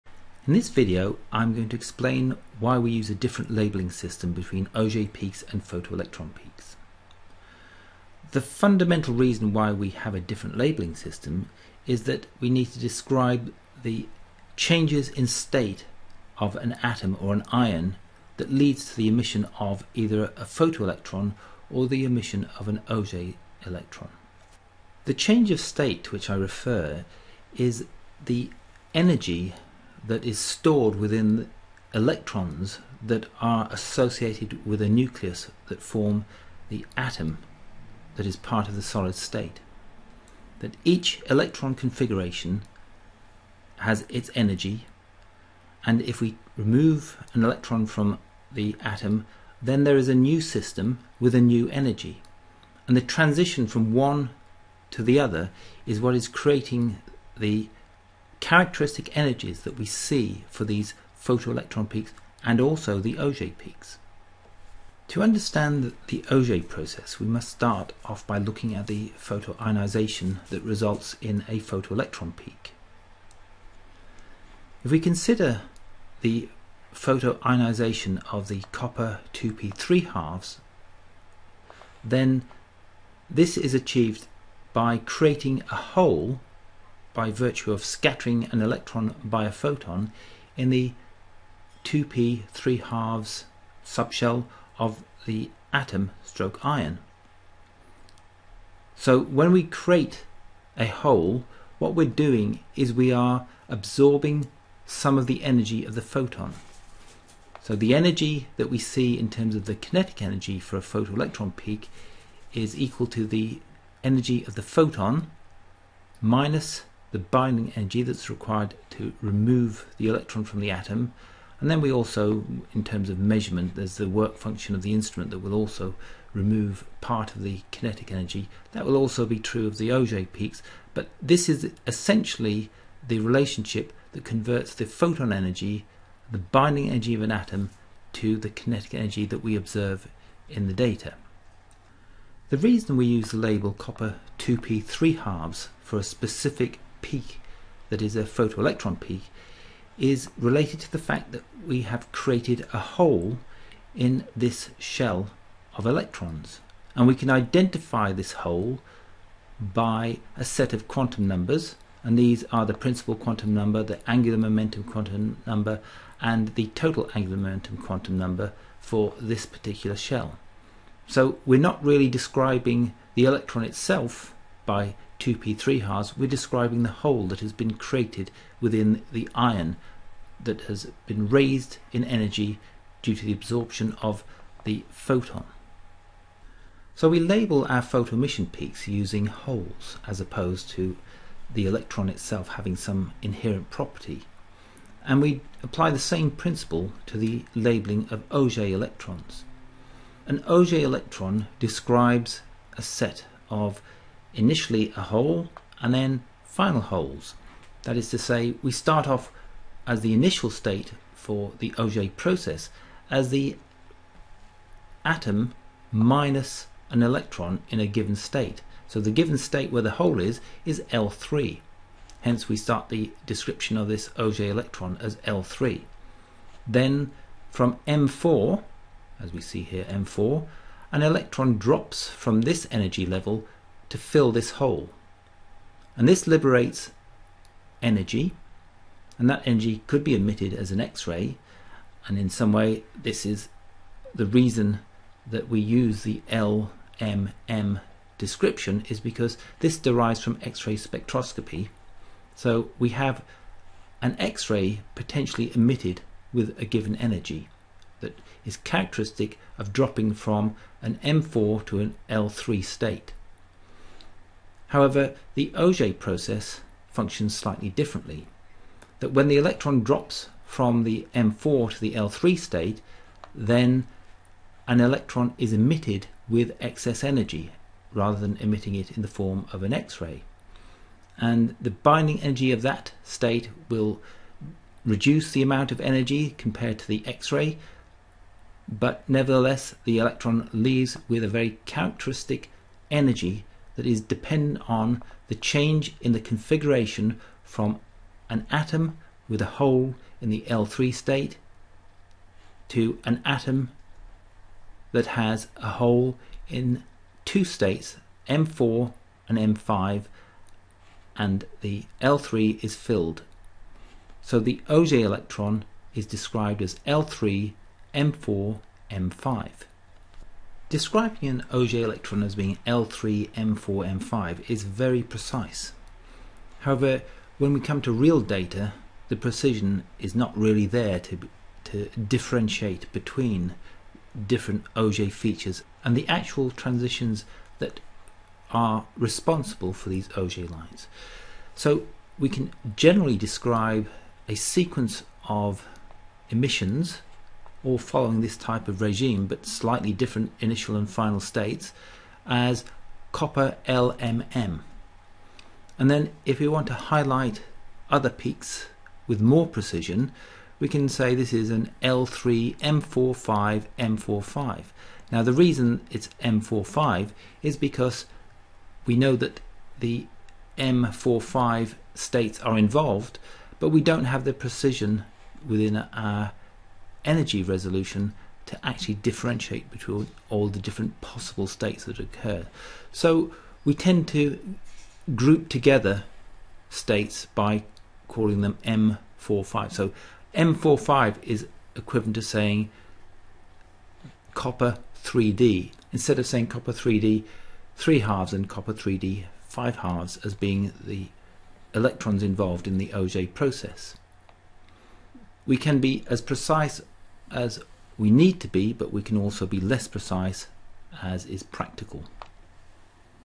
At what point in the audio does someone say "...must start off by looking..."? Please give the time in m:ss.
1:07.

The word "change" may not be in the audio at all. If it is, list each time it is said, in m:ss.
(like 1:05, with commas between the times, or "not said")
0:14, 0:25, 4:55.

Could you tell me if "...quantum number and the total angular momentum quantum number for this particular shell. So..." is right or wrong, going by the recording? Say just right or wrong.
right.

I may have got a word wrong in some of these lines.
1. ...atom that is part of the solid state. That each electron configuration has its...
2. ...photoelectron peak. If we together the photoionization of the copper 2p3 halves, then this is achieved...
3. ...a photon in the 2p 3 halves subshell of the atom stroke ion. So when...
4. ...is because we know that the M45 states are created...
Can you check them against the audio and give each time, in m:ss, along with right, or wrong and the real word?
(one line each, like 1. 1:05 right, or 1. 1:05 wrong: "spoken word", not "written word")
1. 0:36 right
2. 1:11 wrong: "consider", not "together"
3. 1:29 right
4. 6:07 wrong: "involved", not "created".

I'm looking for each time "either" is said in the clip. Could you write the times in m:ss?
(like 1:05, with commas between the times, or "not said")
0:19.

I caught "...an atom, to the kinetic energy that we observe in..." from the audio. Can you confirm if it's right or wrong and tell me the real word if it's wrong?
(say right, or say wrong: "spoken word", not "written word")
right.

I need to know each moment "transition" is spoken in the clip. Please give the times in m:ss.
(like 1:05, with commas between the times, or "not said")
0:53, 5:36.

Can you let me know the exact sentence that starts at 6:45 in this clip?
We can be as precise as we need to be, but we can also be less precise as is practical.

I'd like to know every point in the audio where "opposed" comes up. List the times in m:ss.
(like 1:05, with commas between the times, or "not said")
3:10.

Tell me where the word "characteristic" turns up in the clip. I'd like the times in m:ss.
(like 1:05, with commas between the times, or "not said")
0:58, 4:18, 4:51.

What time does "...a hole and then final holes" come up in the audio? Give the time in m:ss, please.
3:24.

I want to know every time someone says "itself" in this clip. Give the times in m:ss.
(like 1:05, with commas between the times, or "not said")
2:53, 3:12.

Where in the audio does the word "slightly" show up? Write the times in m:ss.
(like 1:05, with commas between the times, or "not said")
4:27, 5:49.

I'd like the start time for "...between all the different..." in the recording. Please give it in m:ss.
6:19.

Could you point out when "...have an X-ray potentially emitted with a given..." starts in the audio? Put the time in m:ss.
4:12.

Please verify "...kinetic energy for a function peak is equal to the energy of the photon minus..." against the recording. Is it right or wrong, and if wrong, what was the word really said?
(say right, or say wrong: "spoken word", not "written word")
wrong: "photoelectron", not "function".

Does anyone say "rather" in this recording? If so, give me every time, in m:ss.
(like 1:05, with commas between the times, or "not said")
4:37.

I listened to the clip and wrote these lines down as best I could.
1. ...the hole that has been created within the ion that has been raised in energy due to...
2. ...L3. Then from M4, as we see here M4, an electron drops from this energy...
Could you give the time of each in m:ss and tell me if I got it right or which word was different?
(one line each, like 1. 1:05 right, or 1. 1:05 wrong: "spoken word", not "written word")
1. 2:56 right
2. 3:45 right.